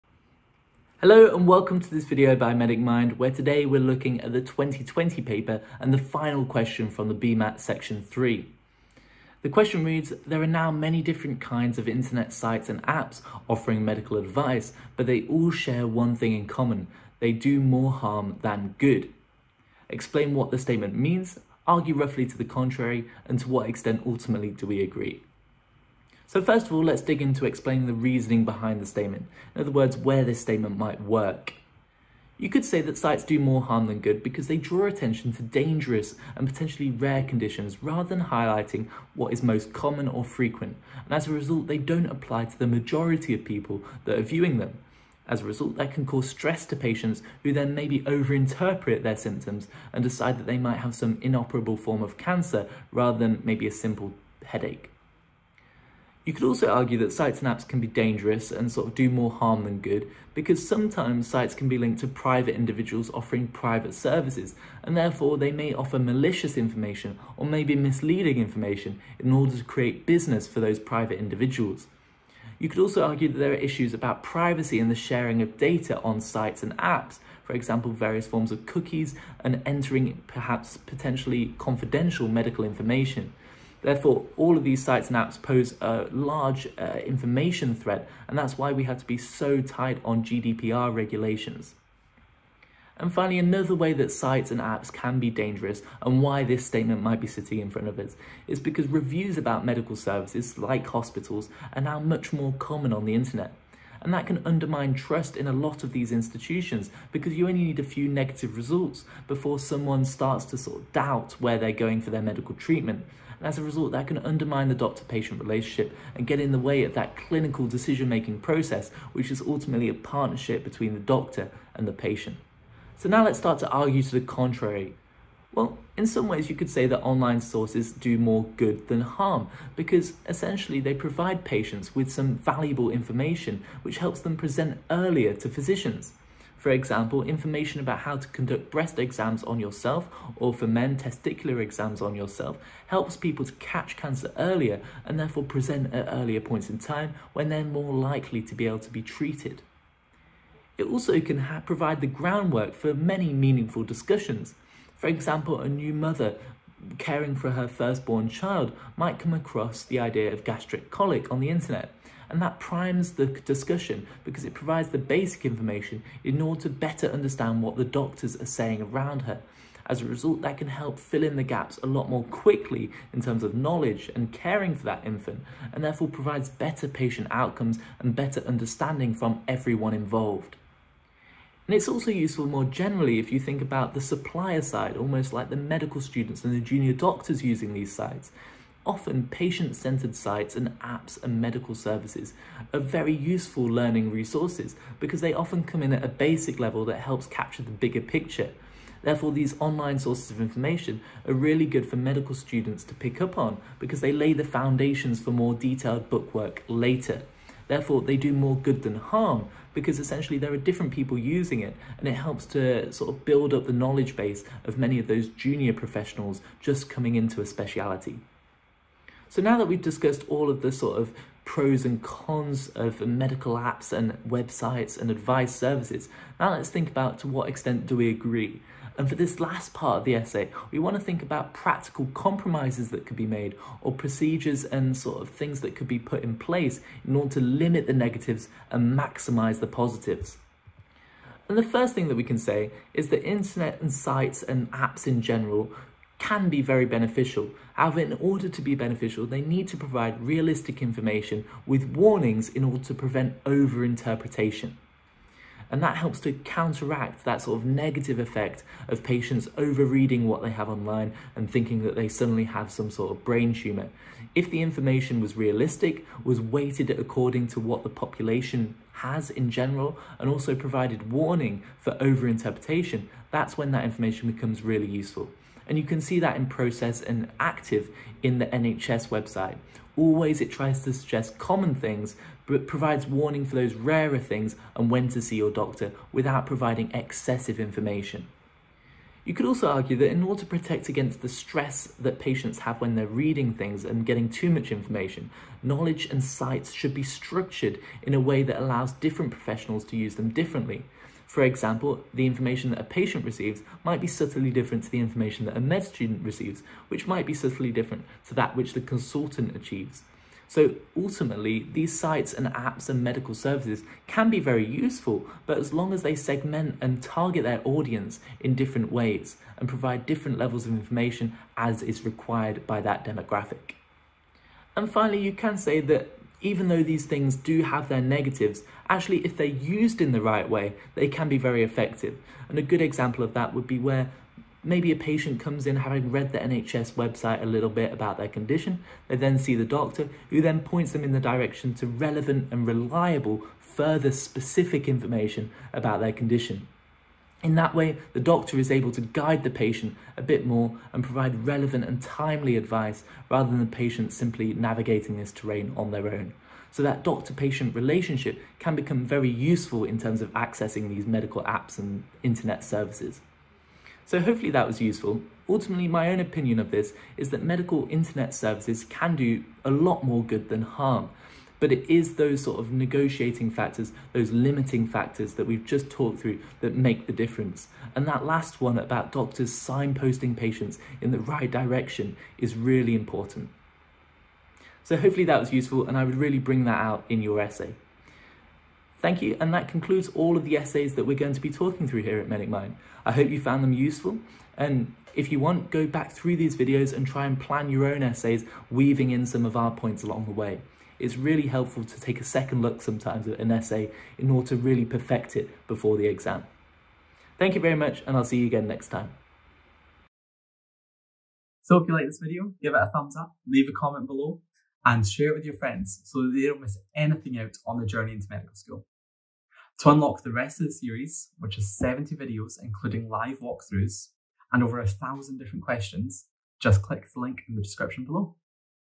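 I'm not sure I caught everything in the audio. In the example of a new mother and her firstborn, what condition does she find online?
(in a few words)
Gastric colic.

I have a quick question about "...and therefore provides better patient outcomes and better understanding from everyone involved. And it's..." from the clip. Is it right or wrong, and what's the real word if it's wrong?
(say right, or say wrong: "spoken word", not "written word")
right.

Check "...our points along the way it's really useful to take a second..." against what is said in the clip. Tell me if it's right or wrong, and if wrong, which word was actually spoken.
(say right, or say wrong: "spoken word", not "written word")
wrong: "helpful", not "useful".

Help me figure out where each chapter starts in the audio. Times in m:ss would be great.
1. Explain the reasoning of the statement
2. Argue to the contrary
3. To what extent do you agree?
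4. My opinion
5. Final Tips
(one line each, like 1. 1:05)
1. 0:28
2. 2:03
3. 3:42
4. 6:04
5. 6:32.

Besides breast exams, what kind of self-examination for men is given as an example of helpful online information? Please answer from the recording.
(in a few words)
Testicular exams.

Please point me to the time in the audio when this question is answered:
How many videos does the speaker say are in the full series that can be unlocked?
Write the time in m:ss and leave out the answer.
7:01.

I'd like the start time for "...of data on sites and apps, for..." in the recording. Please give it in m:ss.
1:15.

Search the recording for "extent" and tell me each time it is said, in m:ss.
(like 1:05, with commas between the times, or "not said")
0:23, 3:47.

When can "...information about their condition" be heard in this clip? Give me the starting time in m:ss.
5:44.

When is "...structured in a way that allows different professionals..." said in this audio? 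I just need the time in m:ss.
4:57.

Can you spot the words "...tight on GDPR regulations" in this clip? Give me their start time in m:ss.
1:29.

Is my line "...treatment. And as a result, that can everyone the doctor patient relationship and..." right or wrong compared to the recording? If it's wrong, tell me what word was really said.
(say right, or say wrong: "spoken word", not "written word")
wrong: "undermine", not "everyone".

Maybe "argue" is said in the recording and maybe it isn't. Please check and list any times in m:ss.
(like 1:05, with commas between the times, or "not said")
0:21, 0:56, 1:13, 2:03, 4:49.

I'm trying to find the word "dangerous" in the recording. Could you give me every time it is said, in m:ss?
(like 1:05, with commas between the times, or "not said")
0:35, 0:57, 1:35.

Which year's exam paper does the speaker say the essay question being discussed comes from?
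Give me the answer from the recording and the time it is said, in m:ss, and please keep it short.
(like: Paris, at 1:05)
2020, at 0:04.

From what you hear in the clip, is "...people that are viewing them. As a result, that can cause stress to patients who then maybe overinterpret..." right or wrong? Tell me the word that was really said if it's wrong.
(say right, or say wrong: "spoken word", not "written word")
right.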